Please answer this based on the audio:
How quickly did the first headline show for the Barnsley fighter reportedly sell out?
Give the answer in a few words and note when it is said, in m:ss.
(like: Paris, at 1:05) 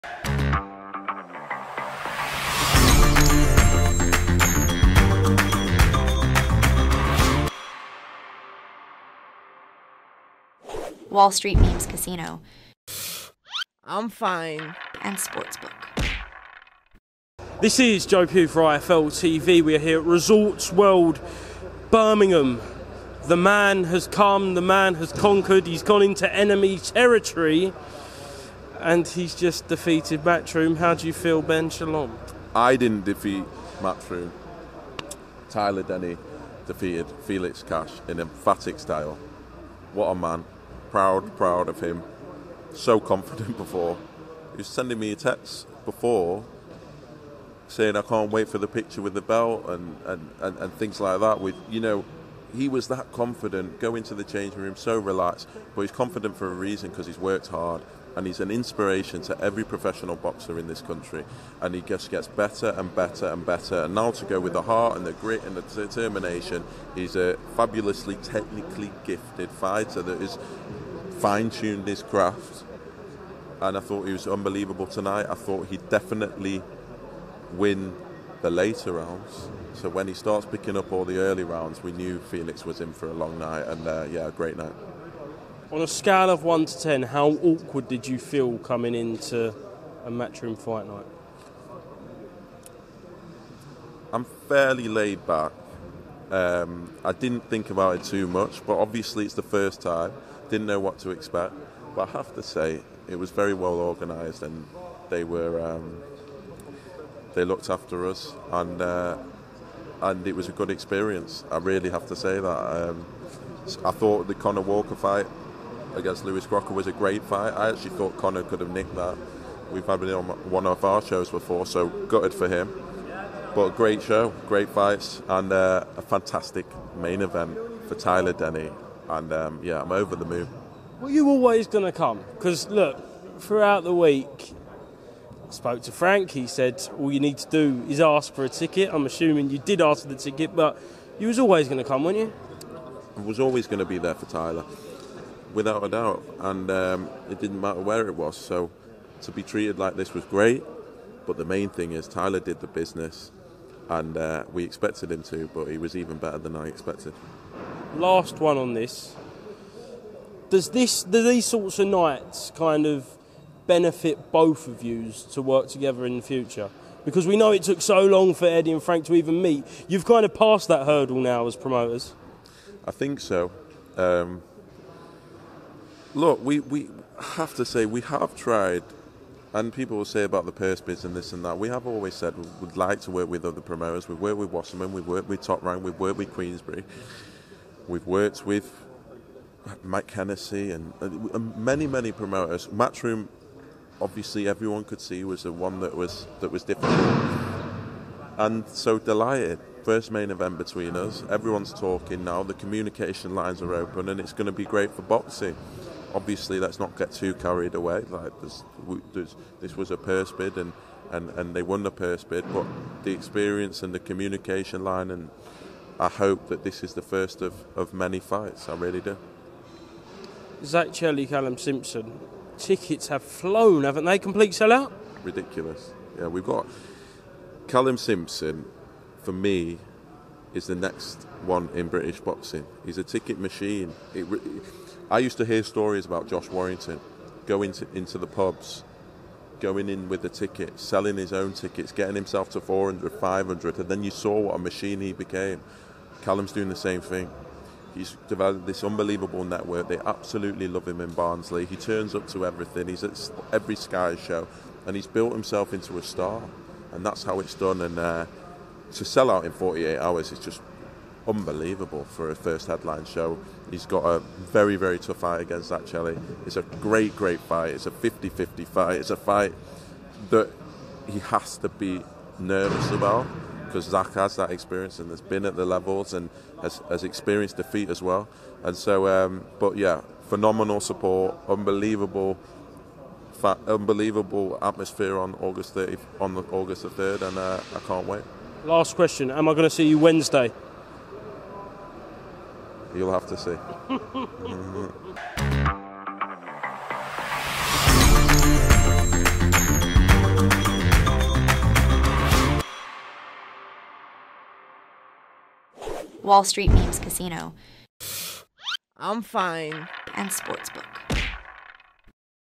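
48 hours, at 4:19.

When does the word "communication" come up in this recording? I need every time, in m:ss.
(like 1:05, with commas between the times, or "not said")
3:22, 3:33.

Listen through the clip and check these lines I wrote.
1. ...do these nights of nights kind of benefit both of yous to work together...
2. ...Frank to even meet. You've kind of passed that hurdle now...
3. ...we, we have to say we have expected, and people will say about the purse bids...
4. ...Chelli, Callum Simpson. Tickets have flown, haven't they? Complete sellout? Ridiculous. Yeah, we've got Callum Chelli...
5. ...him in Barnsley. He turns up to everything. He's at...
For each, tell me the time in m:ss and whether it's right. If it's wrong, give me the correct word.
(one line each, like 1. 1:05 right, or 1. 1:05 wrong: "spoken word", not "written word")
1. 2:41 wrong: "sorts", not "nights"
2. 2:48 right
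3. 2:56 wrong: "tried", not "expected"
4. 3:40 wrong: "Simpson", not "Chelli"
5. 4:10 right.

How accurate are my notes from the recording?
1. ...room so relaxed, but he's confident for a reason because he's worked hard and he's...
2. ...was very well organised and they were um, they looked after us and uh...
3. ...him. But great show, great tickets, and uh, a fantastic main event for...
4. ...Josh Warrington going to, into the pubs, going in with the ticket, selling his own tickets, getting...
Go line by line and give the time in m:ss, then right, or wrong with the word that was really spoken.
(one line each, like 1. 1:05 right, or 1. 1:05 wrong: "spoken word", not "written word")
1. 0:54 right
2. 1:43 right
3. 2:02 wrong: "fights", not "tickets"
4. 3:56 right.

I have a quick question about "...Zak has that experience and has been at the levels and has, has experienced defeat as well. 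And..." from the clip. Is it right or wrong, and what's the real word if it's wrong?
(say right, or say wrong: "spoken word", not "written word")
right.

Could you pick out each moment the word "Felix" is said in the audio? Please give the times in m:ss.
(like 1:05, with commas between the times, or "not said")
0:37, 1:22.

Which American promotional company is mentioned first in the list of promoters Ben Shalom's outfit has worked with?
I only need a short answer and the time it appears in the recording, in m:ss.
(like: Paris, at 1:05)
Wasserman, at 3:04.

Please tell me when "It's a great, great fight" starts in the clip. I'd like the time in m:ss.
4:26.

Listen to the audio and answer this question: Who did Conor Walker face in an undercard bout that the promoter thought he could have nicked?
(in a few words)
Lewis Crocker.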